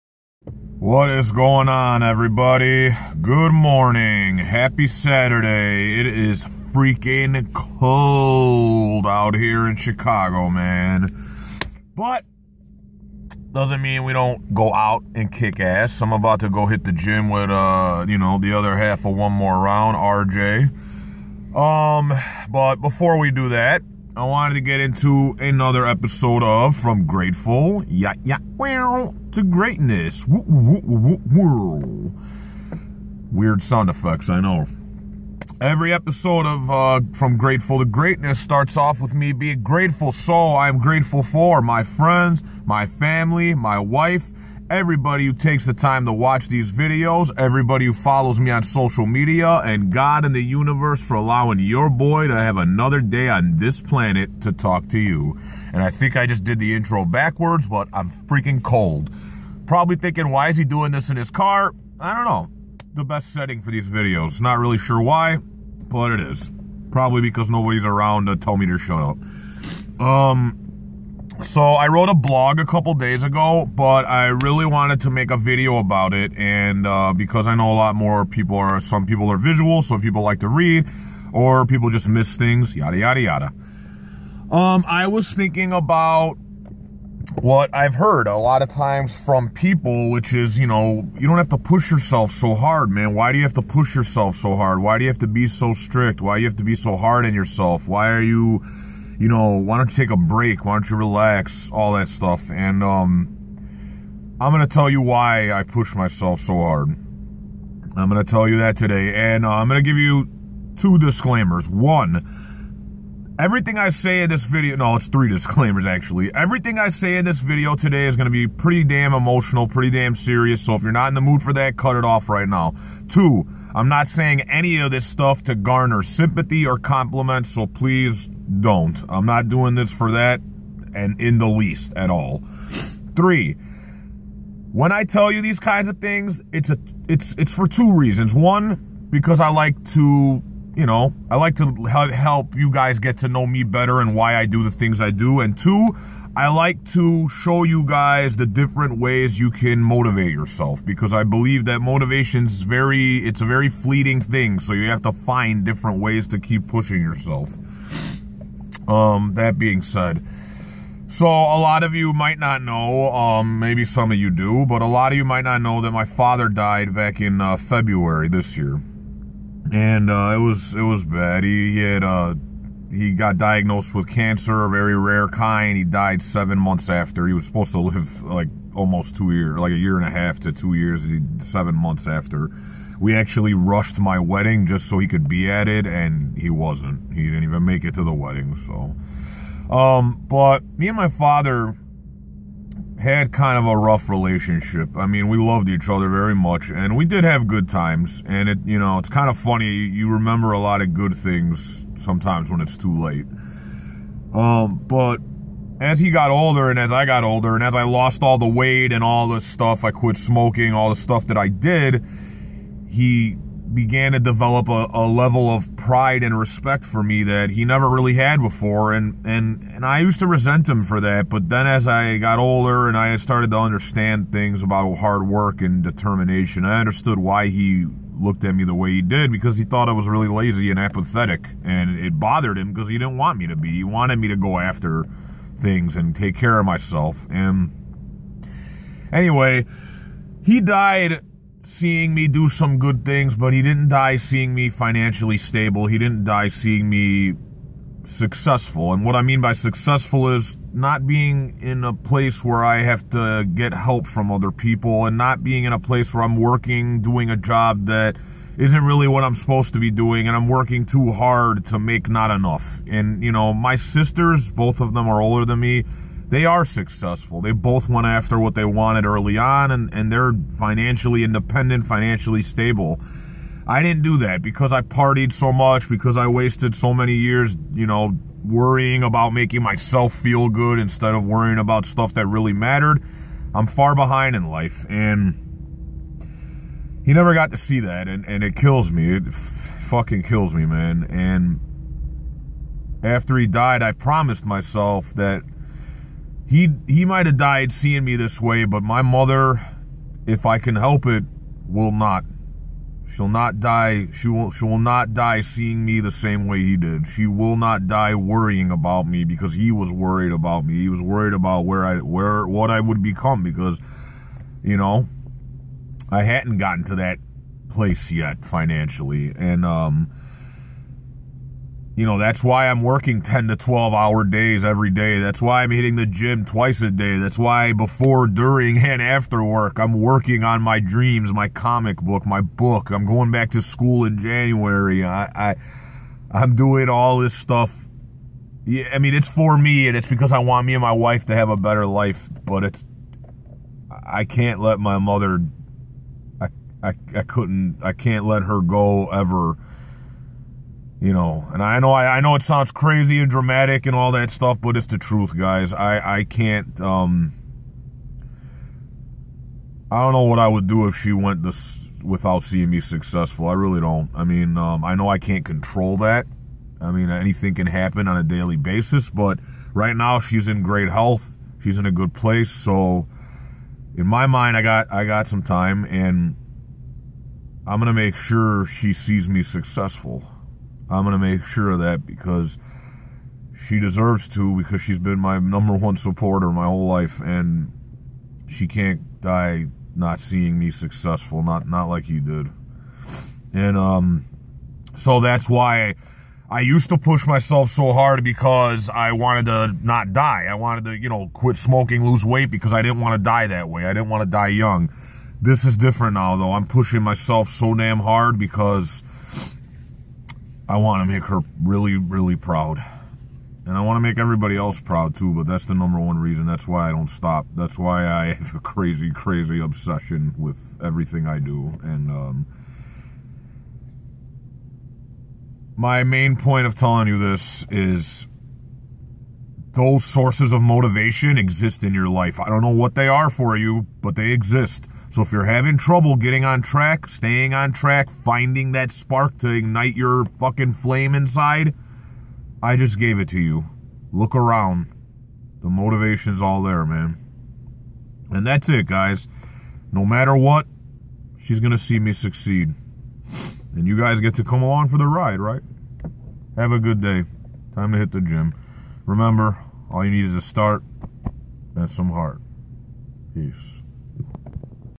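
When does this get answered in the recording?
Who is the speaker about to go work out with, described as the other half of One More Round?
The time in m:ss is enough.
0:19.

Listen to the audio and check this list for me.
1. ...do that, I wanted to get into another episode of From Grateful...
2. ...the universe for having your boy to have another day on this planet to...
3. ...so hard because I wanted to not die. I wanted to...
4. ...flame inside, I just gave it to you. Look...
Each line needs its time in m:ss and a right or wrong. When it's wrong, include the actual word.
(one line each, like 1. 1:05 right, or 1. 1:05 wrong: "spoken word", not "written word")
1. 0:23 right
2. 0:50 wrong: "allowing", not "having"
3. 6:37 right
4. 7:20 right.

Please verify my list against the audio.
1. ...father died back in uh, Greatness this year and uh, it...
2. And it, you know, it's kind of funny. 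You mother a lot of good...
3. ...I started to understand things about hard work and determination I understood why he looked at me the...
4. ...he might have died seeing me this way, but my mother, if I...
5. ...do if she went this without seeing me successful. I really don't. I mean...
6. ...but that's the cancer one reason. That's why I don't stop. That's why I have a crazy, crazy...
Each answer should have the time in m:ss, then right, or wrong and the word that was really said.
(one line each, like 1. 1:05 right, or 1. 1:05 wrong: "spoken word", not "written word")
1. 2:46 wrong: "February", not "Greatness"
2. 3:18 wrong: "remember", not "mother"
3. 3:42 right
4. 4:56 right
5. 6:00 right
6. 6:55 wrong: "number", not "cancer".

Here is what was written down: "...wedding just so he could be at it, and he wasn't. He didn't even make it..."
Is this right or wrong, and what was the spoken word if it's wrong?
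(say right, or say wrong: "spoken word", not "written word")
right.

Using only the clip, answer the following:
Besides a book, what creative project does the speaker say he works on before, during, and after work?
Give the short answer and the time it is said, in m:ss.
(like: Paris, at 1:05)
Comic book, at 5:31.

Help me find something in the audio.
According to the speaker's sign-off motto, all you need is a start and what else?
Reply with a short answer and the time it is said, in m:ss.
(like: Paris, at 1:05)
Some heart, at 7:41.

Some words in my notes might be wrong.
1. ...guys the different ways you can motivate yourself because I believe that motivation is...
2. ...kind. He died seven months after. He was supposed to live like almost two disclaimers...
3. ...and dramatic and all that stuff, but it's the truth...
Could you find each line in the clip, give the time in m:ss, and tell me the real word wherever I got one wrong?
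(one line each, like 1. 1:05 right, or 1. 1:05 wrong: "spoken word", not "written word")
1. 2:27 right
2. 2:55 wrong: "years", not "disclaimers"
3. 5:53 right.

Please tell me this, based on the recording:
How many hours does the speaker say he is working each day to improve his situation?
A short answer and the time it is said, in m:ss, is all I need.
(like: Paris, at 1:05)
10 to 12, at 5:23.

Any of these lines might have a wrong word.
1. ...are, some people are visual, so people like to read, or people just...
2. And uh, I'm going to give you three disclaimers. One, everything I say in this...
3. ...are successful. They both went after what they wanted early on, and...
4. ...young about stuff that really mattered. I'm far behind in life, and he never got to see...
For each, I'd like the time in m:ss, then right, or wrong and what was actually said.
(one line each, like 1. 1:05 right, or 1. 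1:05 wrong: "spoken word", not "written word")
1. 1:18 right
2. 1:49 wrong: "two", not "three"
3. 4:26 right
4. 4:41 wrong: "worrying", not "young".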